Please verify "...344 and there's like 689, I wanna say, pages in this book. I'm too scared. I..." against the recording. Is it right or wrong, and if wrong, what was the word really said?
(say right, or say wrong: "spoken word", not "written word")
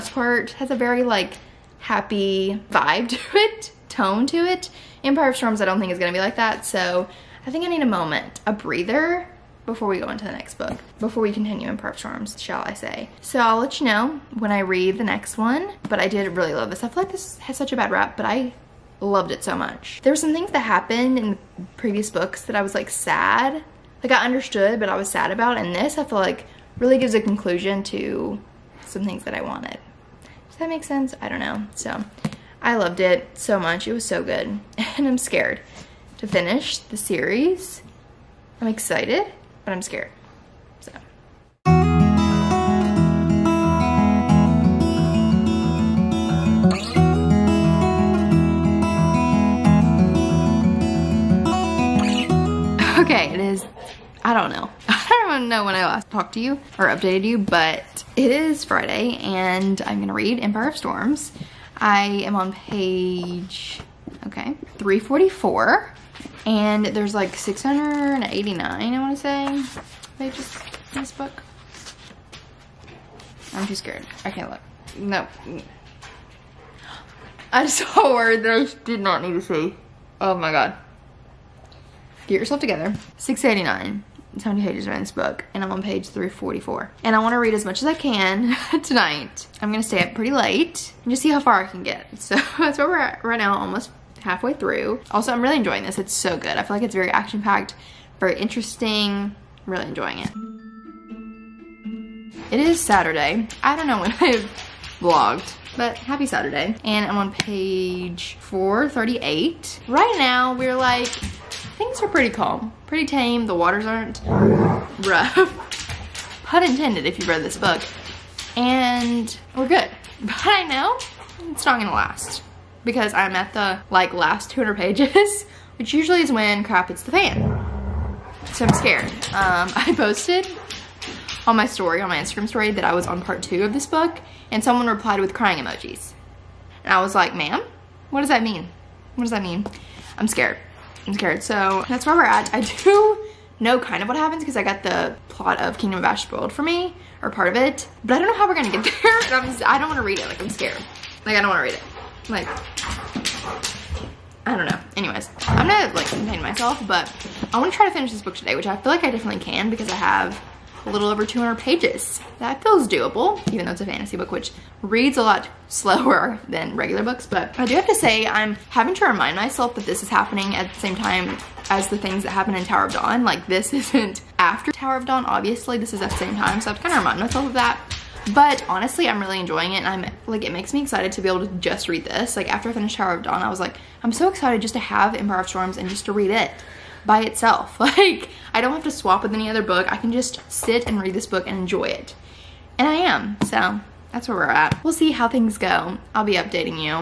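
right.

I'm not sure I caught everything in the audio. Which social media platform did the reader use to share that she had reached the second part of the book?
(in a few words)
Instagram.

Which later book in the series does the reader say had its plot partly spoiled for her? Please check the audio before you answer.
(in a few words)
Kingdom of Ash.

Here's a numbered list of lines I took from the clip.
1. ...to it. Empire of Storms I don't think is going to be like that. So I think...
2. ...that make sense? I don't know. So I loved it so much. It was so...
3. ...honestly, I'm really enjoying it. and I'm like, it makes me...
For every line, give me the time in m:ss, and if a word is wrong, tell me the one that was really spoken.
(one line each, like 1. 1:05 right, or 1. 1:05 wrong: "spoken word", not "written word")
1. 0:04 right
2. 0:30 right
3. 2:58 right.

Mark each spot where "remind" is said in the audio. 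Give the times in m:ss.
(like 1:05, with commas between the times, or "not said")
2:49, 2:56.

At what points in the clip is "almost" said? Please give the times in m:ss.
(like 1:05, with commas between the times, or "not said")
1:33.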